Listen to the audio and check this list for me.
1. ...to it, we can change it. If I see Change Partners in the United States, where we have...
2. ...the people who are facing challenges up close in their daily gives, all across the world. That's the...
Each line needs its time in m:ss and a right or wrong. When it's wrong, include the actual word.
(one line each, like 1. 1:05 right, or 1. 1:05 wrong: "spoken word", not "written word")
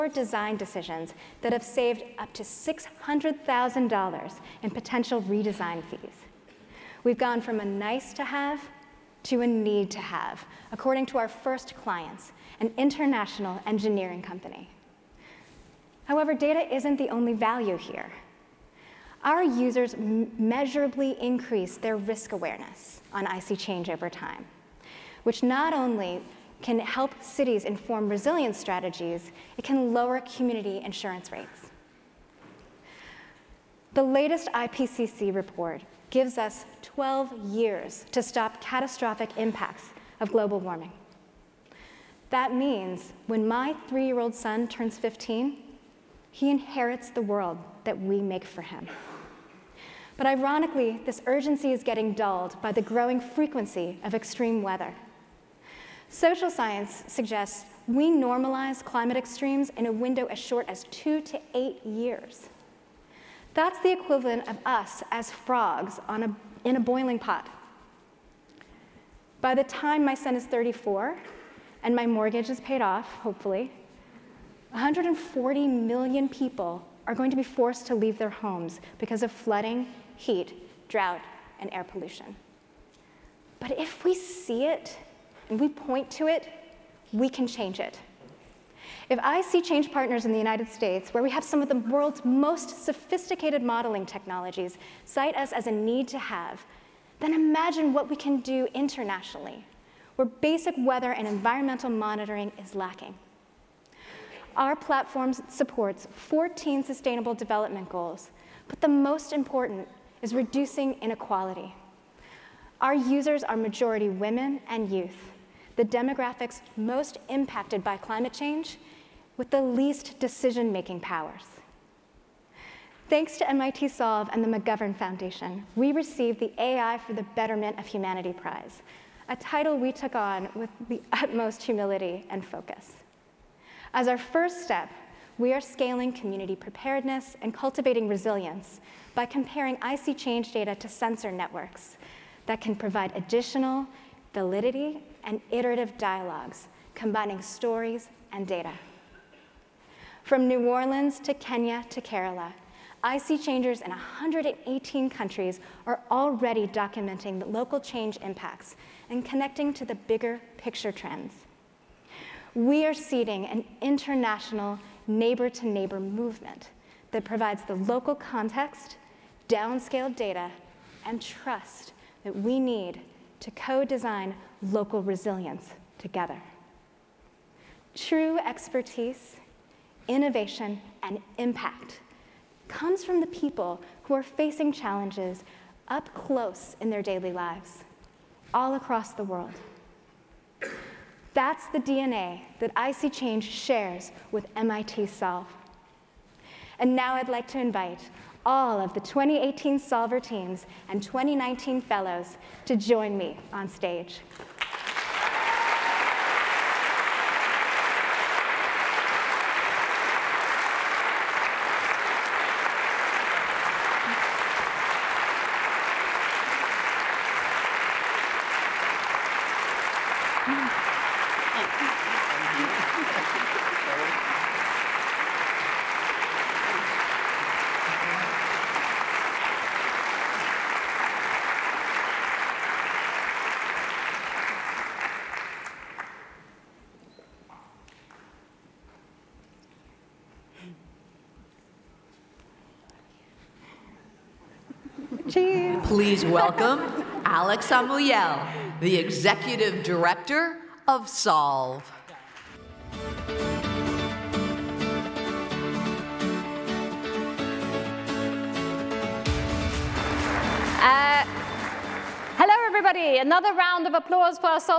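1. 1:26 right
2. 3:03 wrong: "lives", not "gives".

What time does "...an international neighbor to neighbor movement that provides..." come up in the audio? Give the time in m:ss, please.
2:43.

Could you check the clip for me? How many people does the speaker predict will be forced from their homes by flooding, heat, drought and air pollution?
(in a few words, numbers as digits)
140 million.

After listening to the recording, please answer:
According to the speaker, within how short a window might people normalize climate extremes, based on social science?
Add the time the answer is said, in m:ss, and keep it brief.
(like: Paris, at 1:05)
2 to 8 years, at 1:00.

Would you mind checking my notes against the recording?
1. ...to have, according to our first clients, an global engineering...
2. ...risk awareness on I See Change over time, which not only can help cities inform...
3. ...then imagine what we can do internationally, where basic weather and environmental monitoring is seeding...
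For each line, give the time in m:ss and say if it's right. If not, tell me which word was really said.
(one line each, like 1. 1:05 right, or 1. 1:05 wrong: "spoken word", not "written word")
1. 0:09 wrong: "international", not "global"
2. 0:21 right
3. 1:37 wrong: "lacking", not "seeding".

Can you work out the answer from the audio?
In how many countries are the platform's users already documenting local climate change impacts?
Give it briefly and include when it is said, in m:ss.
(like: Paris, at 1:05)
118, at 2:33.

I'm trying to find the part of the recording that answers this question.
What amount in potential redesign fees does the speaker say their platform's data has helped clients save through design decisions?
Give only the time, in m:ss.
0:02.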